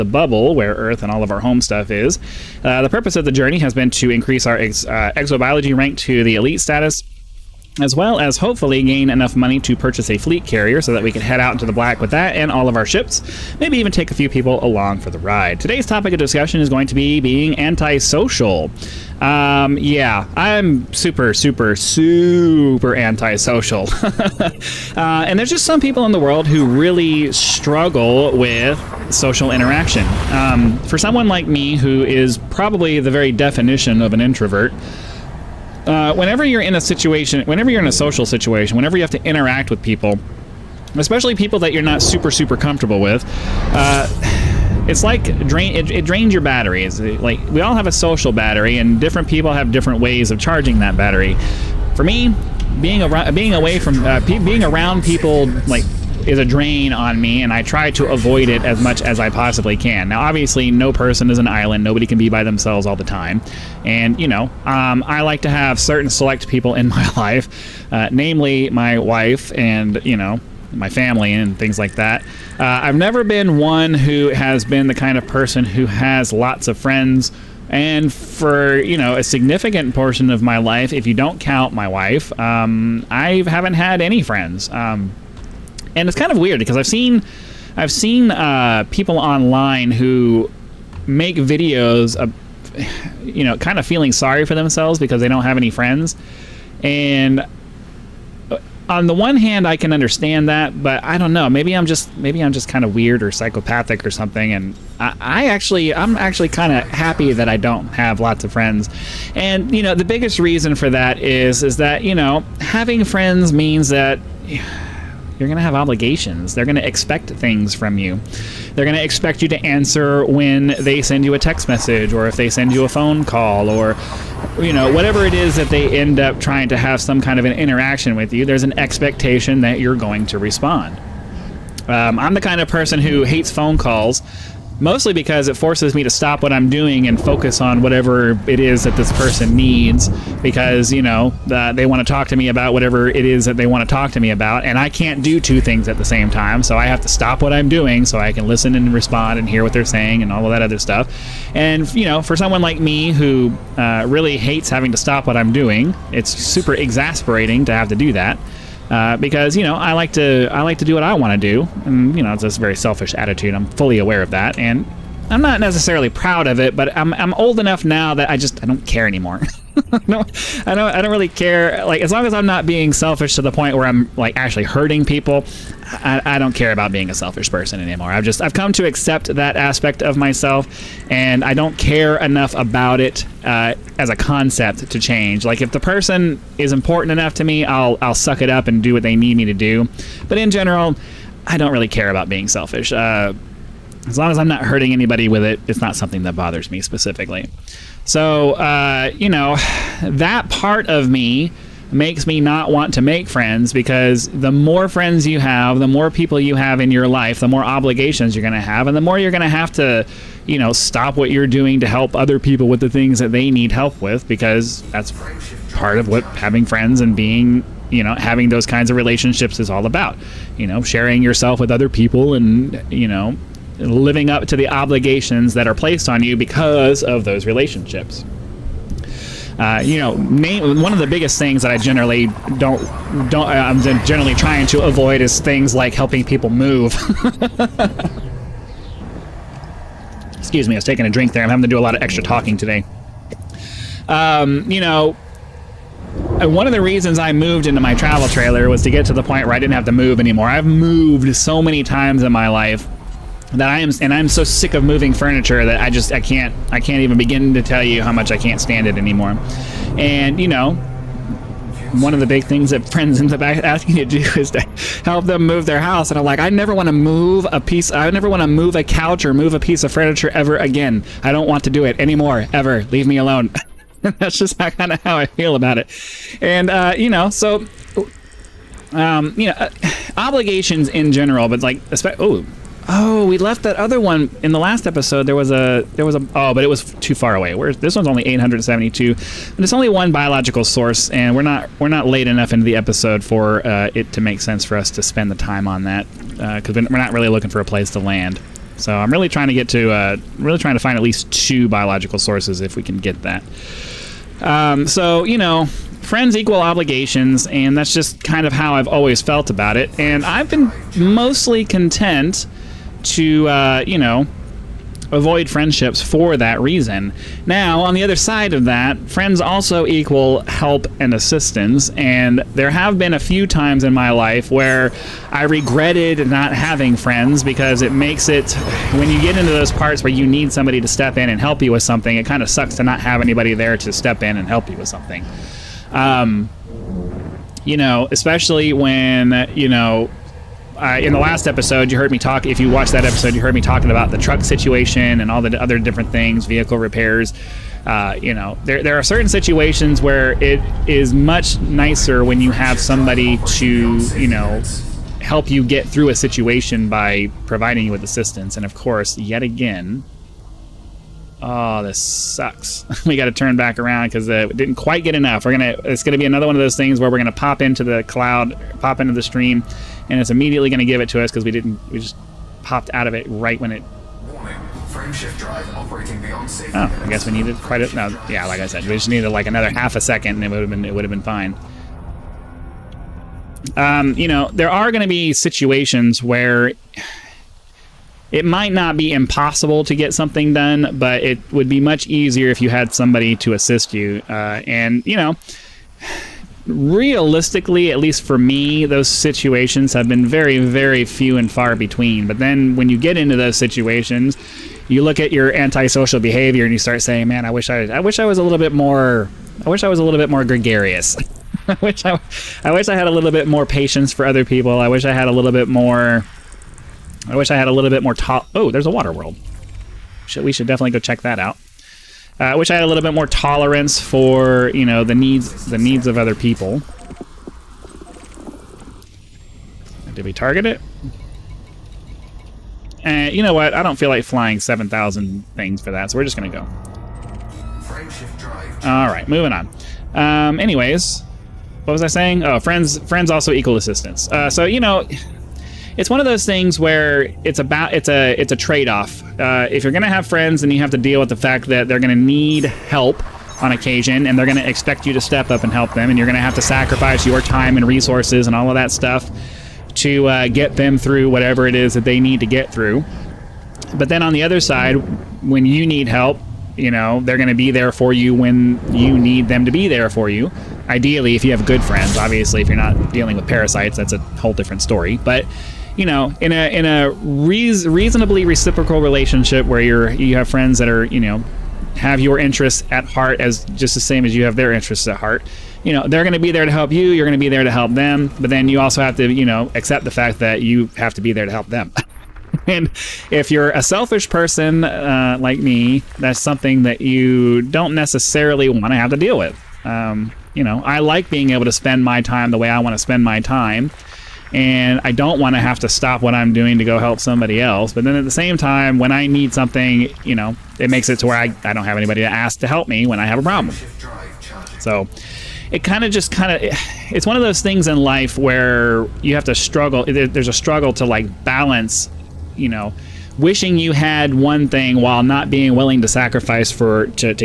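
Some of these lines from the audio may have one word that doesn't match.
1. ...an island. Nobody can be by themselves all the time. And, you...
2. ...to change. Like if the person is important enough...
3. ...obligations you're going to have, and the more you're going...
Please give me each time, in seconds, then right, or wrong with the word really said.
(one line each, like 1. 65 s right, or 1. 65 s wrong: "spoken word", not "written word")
1. 61 s right
2. 184 s right
3. 207 s right.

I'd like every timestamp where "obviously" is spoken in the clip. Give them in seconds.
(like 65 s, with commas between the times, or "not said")
60 s, 472 s.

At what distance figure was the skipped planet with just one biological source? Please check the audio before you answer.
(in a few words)
872.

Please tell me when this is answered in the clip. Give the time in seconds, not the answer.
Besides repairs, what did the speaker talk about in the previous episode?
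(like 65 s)
344 s.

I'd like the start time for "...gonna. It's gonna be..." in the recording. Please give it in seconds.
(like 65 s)
365 s.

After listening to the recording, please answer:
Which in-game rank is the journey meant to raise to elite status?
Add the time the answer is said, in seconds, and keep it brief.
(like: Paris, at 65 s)
Exobiology, at 5 s.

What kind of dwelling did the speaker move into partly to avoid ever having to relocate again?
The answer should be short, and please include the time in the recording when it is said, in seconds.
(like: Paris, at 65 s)
Travel trailer, at 247 s.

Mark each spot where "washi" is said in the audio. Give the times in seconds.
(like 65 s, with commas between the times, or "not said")
not said.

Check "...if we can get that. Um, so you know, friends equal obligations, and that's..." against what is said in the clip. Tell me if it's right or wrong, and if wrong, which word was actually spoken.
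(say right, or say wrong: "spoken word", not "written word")
right.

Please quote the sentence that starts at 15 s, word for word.
Today's topic of discussion is going to be being antisocial.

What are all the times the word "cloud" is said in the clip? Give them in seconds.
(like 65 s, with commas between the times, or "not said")
368 s.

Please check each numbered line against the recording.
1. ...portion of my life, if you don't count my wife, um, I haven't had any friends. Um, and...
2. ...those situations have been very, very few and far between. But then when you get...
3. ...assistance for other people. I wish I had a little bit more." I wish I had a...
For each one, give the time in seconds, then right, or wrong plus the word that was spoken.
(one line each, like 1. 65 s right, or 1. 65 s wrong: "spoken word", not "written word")
1. 79 s right
2. 398 s right
3. 413 s wrong: "patience", not "assistance".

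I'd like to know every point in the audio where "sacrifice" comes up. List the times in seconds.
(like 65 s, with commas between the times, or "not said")
456 s, 526 s.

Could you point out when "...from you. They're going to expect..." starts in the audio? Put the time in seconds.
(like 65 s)
117 s.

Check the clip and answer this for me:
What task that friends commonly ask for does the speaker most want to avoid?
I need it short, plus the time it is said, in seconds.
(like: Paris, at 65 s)
Helping people move, at 235 s.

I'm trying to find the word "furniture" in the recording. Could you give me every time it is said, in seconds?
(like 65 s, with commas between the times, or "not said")
255 s, 269 s.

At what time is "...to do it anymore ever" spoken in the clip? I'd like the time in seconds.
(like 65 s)
271 s.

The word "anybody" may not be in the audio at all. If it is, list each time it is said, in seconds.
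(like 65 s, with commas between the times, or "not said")
194 s, 333 s, 511 s.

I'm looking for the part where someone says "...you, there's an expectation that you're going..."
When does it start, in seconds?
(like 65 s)
128 s.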